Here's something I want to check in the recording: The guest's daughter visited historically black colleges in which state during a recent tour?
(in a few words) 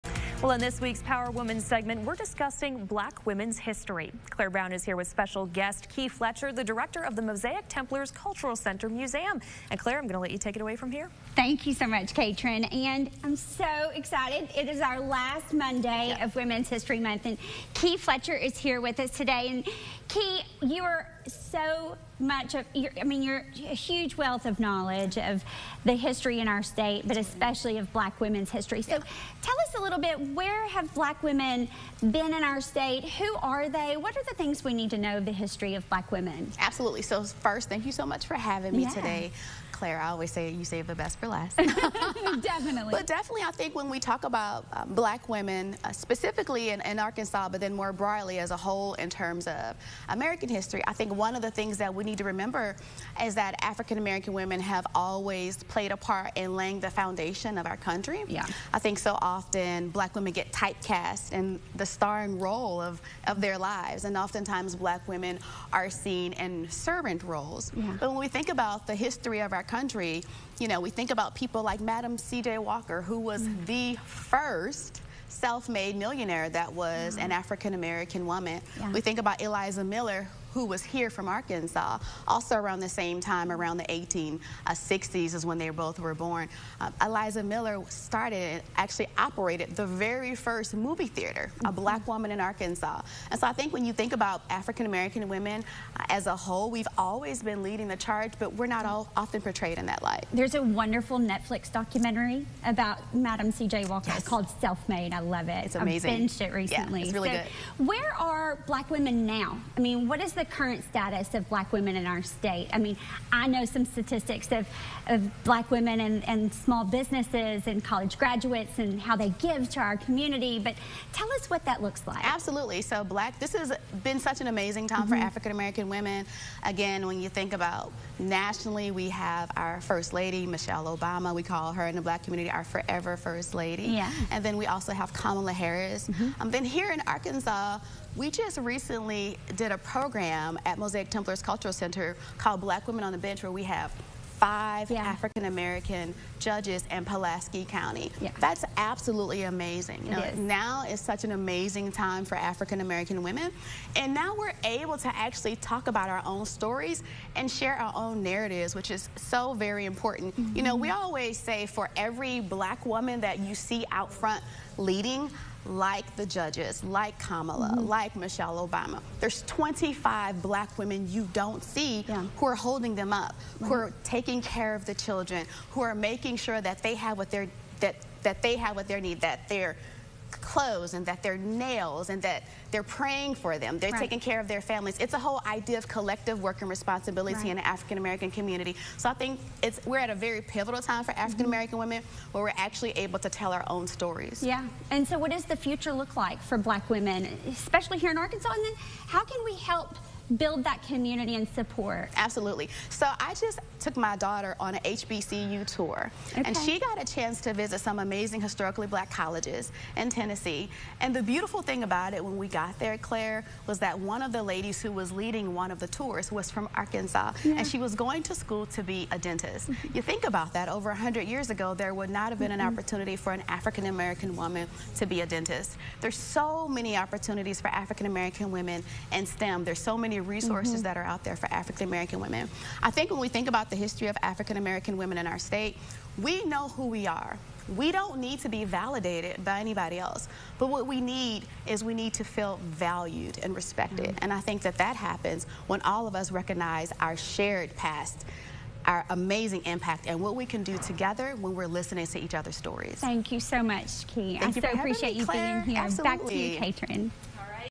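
Tennessee.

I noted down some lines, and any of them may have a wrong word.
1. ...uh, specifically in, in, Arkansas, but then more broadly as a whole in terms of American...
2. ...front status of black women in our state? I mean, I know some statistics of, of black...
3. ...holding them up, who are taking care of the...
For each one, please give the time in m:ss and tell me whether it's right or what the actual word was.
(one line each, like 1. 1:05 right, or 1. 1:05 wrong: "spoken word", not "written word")
1. 0:45 right
2. 1:50 wrong: "current", not "front"
3. 2:52 right.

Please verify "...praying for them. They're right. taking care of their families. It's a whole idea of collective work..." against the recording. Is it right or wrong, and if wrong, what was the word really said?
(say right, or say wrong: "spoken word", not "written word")
right.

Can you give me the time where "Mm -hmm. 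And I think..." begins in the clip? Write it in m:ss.
4:04.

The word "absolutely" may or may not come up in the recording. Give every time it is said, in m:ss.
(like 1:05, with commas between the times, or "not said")
0:36, 2:02, 2:28, 3:22, 4:15.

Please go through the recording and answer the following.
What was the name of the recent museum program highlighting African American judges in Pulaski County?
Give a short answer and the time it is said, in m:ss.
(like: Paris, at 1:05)
Black Women on the Bench, at 2:22.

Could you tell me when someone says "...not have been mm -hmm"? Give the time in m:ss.
3:42.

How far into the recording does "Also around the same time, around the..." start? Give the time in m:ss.
1:22.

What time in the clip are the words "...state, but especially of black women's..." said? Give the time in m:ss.
0:26.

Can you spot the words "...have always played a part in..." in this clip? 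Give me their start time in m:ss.
0:54.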